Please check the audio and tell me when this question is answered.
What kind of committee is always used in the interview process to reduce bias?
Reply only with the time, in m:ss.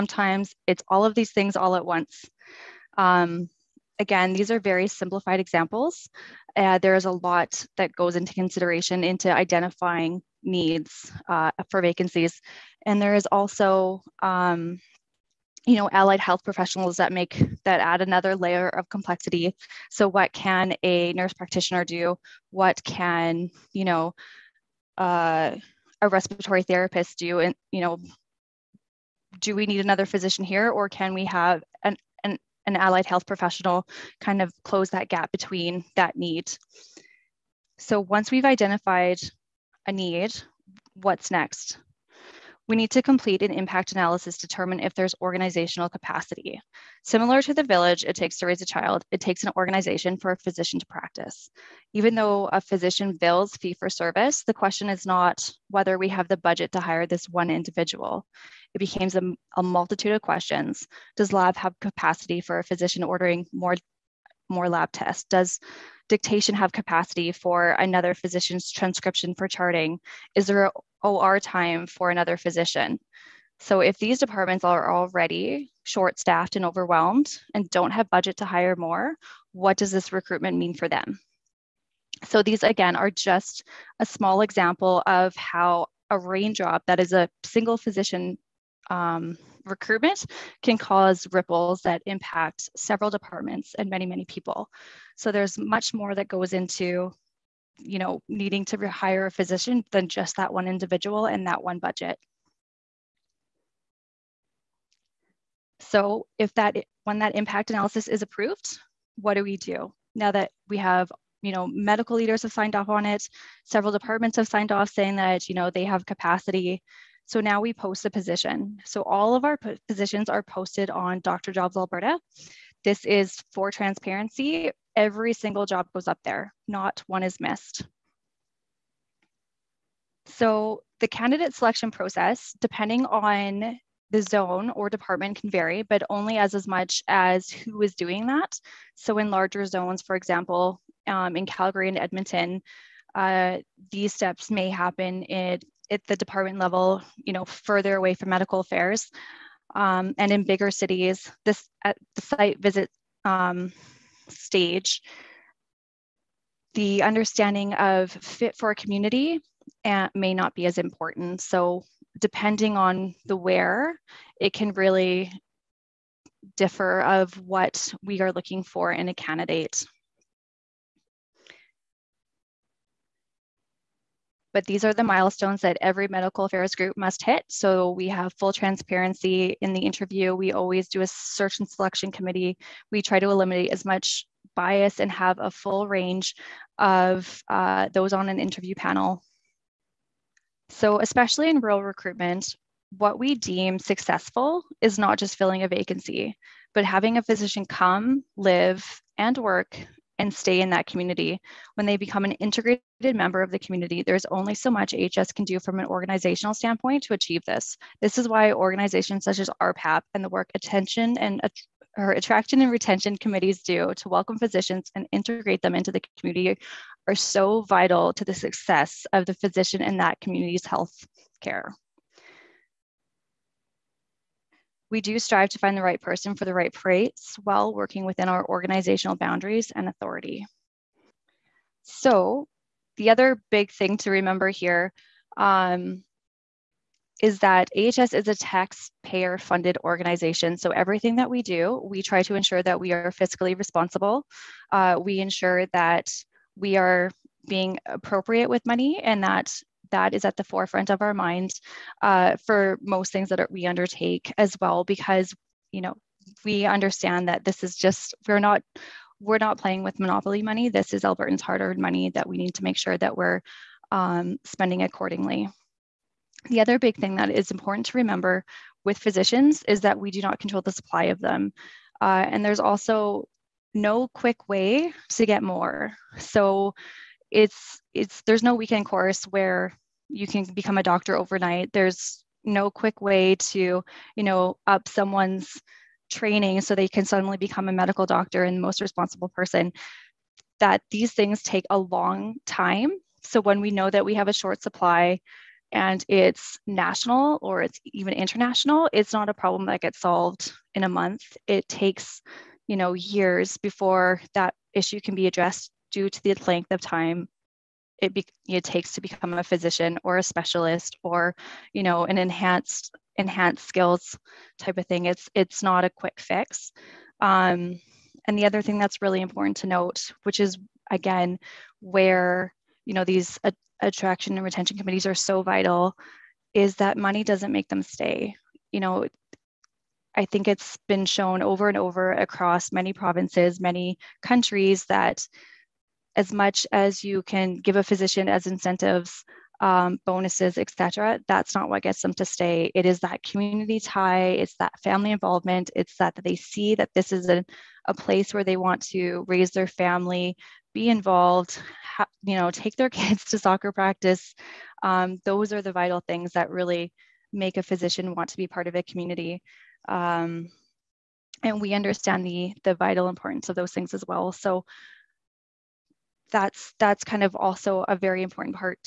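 3:01.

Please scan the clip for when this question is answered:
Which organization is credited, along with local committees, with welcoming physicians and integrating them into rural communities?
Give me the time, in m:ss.
3:29.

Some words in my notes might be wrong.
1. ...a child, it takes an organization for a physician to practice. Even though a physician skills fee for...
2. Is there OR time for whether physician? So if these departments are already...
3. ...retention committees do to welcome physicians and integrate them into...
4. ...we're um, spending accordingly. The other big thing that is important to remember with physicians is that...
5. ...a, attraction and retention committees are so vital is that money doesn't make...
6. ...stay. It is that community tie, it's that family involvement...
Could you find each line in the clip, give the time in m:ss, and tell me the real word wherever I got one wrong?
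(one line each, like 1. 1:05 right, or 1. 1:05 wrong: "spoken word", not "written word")
1. 0:48 wrong: "bills", not "skills"
2. 1:10 wrong: "another", not "whether"
3. 3:32 right
4. 4:23 right
5. 5:23 right
6. 5:42 right.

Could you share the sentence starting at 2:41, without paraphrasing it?
So depending on the where, it can really differ of what we are looking for in a candidate.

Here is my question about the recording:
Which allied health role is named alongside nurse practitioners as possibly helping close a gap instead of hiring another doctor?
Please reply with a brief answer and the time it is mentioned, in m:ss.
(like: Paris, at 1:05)
respiratory therapist, at 0:26.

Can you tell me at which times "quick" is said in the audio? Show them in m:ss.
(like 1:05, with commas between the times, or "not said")
4:34, 4:42, 5:15.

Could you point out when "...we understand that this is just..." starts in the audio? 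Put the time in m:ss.
4:16.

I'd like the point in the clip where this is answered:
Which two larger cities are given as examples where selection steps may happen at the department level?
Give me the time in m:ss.
2:21.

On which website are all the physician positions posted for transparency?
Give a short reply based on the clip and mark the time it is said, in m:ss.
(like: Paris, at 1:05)
Dr. Jobs Alberta, at 2:01.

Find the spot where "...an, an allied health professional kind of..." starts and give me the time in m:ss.
0:32.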